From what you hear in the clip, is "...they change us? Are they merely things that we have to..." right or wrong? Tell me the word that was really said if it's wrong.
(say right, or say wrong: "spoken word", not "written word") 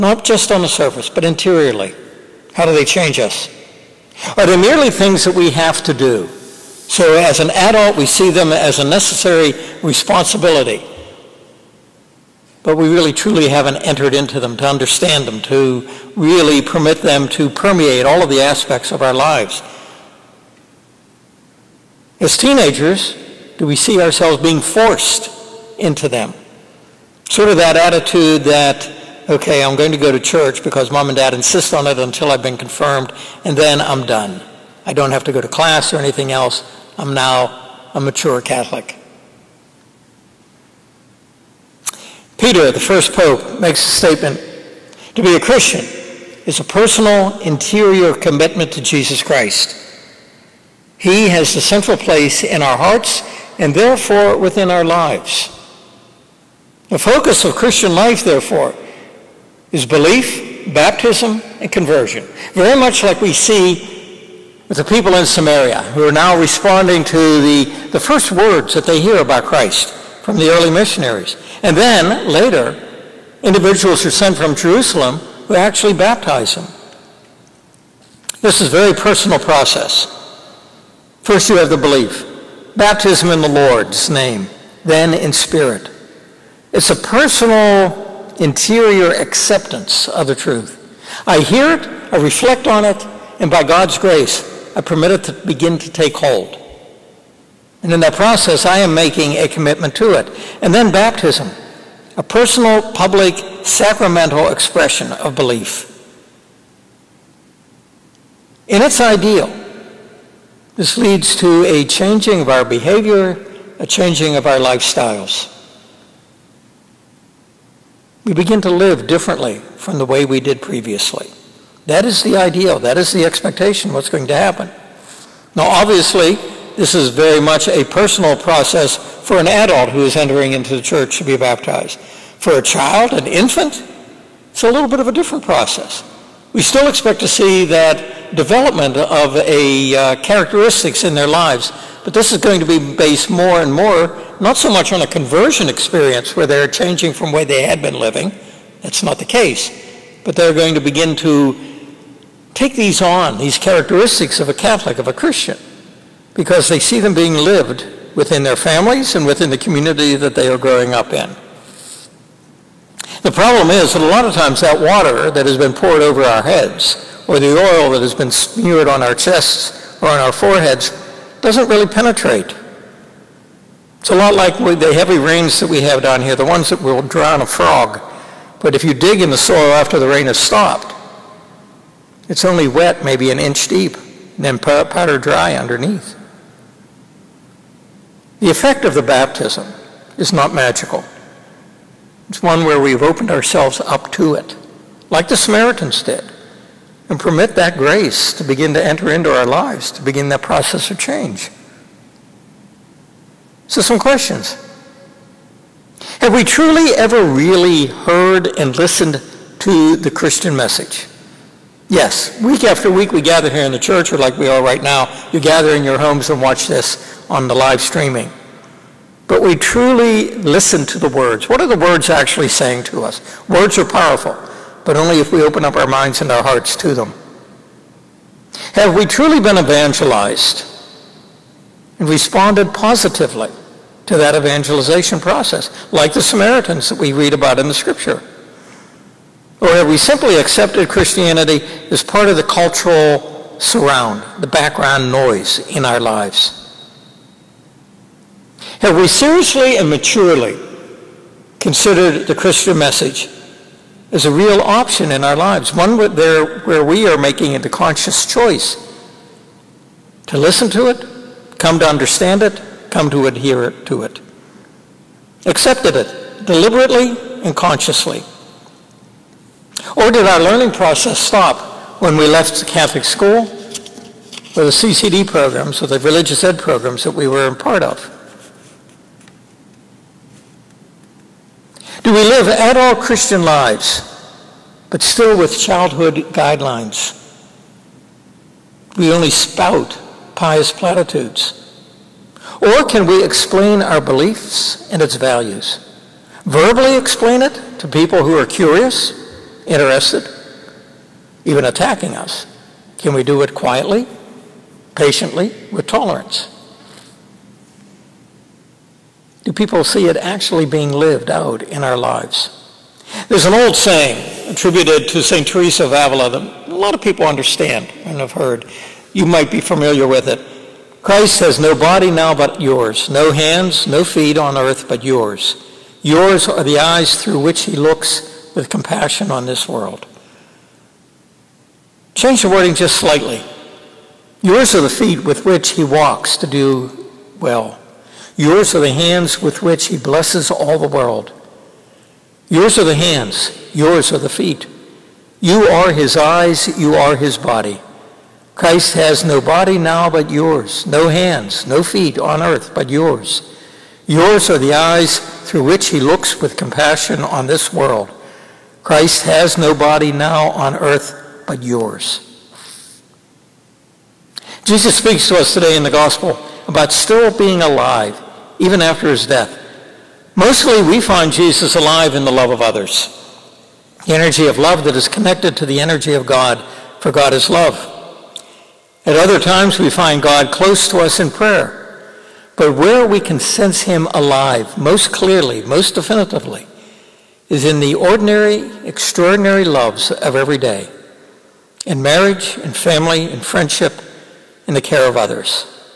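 right.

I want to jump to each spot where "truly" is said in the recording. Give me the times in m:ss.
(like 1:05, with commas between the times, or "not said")
0:13, 3:26, 3:39, 3:49.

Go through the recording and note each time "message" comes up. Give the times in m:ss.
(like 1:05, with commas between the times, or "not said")
3:30, 4:12.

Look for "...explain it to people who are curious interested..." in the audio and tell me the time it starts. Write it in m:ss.
4:56.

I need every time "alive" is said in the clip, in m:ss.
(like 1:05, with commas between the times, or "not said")
6:07, 6:11, 6:24.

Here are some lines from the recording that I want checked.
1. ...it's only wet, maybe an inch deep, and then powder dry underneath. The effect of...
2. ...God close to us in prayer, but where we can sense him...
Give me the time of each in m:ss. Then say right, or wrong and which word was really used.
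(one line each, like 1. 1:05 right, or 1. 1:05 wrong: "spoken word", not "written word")
1. 3:02 right
2. 6:20 right.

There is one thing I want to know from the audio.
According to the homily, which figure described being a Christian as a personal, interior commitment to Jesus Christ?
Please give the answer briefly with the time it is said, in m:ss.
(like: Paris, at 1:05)
Peter, at 0:42.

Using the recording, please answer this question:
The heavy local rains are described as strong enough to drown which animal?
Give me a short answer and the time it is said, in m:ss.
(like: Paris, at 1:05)
a frog, at 2:57.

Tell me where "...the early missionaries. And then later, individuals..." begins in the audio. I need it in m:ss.
1:10.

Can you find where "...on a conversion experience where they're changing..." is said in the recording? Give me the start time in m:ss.
2:24.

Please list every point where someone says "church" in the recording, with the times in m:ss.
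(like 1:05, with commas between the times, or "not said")
0:30, 2:10, 3:33.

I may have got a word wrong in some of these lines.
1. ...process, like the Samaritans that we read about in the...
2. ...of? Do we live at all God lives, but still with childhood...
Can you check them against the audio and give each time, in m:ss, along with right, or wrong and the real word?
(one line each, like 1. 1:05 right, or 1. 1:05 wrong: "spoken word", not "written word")
1. 3:55 right
2. 4:37 wrong: "Christian", not "God".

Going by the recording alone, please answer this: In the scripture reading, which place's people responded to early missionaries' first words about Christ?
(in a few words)
Samaria.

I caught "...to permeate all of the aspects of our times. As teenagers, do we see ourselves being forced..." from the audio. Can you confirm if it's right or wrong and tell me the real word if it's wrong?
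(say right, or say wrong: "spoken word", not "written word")
wrong: "lives", not "times".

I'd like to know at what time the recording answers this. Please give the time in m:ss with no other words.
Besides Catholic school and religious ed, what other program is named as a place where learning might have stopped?
4:34.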